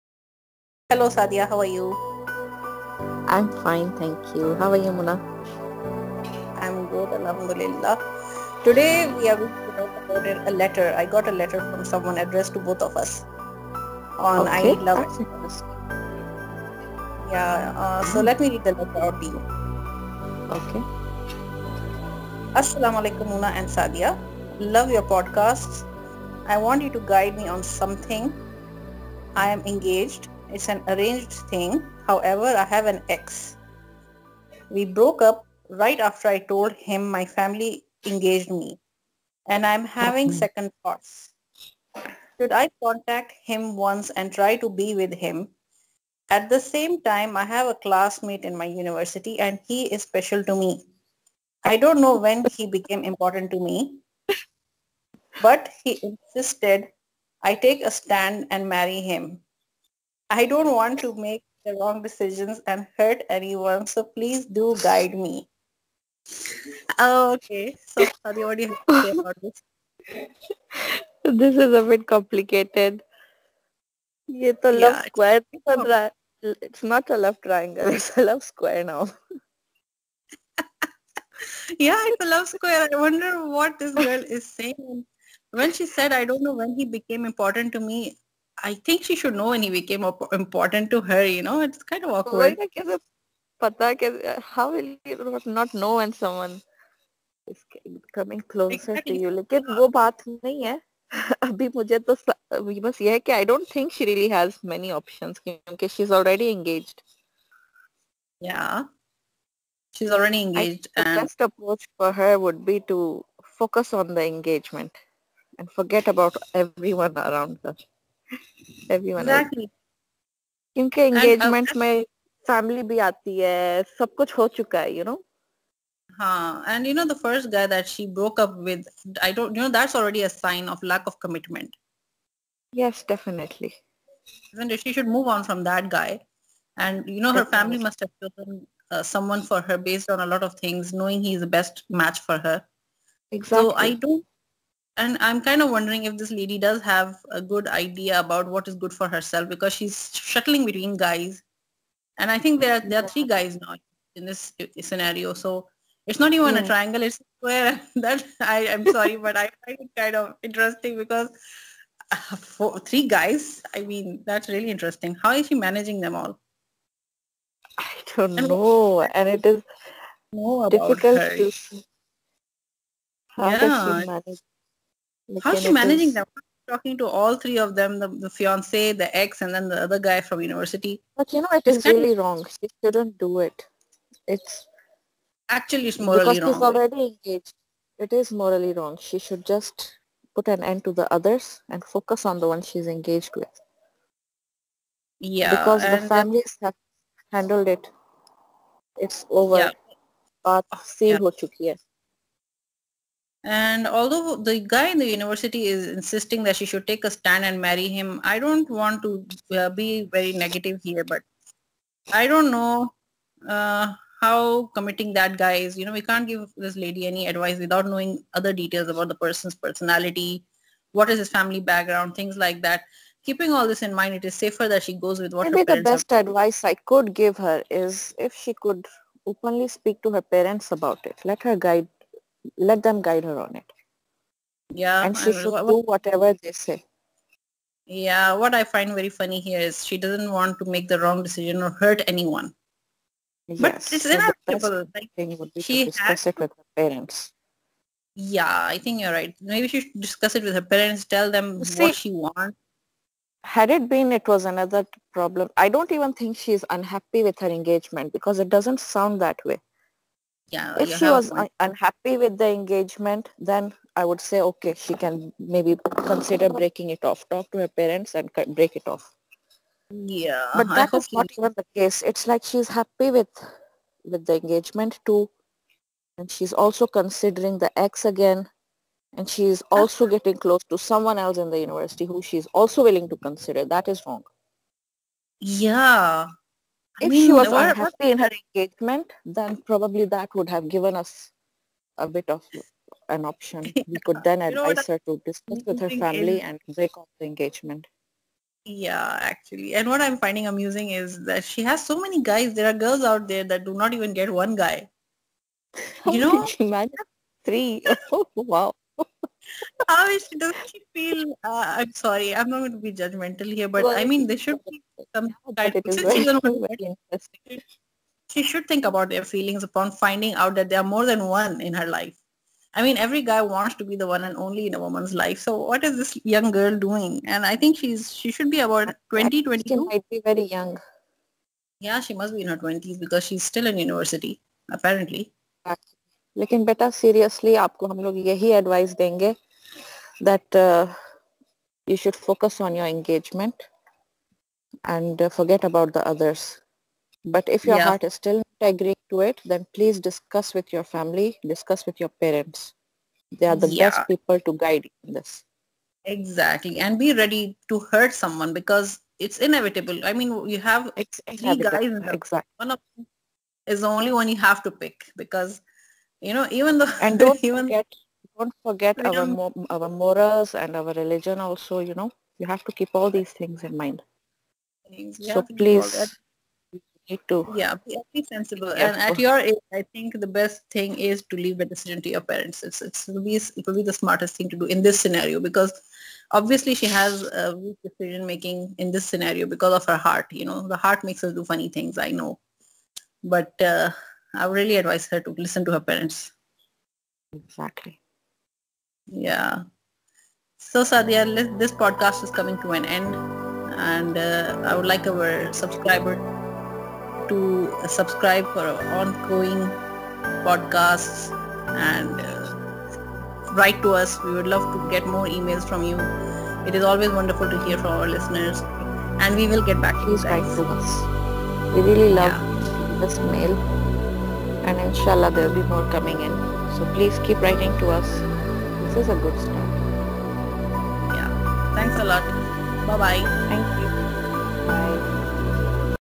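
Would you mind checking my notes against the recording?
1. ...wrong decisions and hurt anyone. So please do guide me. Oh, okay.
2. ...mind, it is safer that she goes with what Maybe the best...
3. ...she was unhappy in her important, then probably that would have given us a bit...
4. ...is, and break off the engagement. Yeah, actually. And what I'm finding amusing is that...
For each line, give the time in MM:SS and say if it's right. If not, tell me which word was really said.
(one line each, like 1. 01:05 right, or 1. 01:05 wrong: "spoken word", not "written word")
1. 01:01 right
2. 03:43 right
3. 04:47 wrong: "engagement", not "important"
4. 04:56 right.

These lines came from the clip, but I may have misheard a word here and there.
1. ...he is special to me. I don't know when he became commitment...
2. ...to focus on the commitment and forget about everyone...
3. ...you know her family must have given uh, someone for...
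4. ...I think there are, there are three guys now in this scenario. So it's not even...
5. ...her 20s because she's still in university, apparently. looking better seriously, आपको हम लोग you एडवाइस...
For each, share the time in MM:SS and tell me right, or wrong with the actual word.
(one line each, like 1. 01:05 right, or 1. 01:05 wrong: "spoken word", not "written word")
1. 00:49 wrong: "important", not "commitment"
2. 01:52 wrong: "engagement", not "commitment"
3. 02:17 wrong: "chosen", not "given"
4. 02:32 right
5. 05:32 right.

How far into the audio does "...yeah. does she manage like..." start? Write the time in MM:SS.
02:53.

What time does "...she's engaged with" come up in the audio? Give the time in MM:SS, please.
03:12.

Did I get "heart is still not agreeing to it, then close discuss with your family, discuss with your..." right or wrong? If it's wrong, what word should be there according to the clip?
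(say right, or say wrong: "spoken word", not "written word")
wrong: "please", not "close".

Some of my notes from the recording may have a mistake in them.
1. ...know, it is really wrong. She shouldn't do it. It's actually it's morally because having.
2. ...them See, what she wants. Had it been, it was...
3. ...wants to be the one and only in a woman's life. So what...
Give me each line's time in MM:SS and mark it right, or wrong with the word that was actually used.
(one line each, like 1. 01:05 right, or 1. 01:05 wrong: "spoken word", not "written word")
1. 03:01 wrong: "wrong", not "having"
2. 04:11 right
3. 05:23 right.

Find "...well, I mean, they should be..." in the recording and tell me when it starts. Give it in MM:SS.
05:13.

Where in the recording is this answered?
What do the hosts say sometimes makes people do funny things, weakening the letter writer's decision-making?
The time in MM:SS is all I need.
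06:30.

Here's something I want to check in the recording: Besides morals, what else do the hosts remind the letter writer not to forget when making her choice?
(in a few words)
Religion.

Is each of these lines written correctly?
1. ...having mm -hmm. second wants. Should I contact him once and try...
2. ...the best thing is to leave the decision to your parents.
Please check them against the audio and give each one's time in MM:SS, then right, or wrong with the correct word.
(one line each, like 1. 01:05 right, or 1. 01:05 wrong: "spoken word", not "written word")
1. 00:39 wrong: "thoughts", not "wants"
2. 06:20 right.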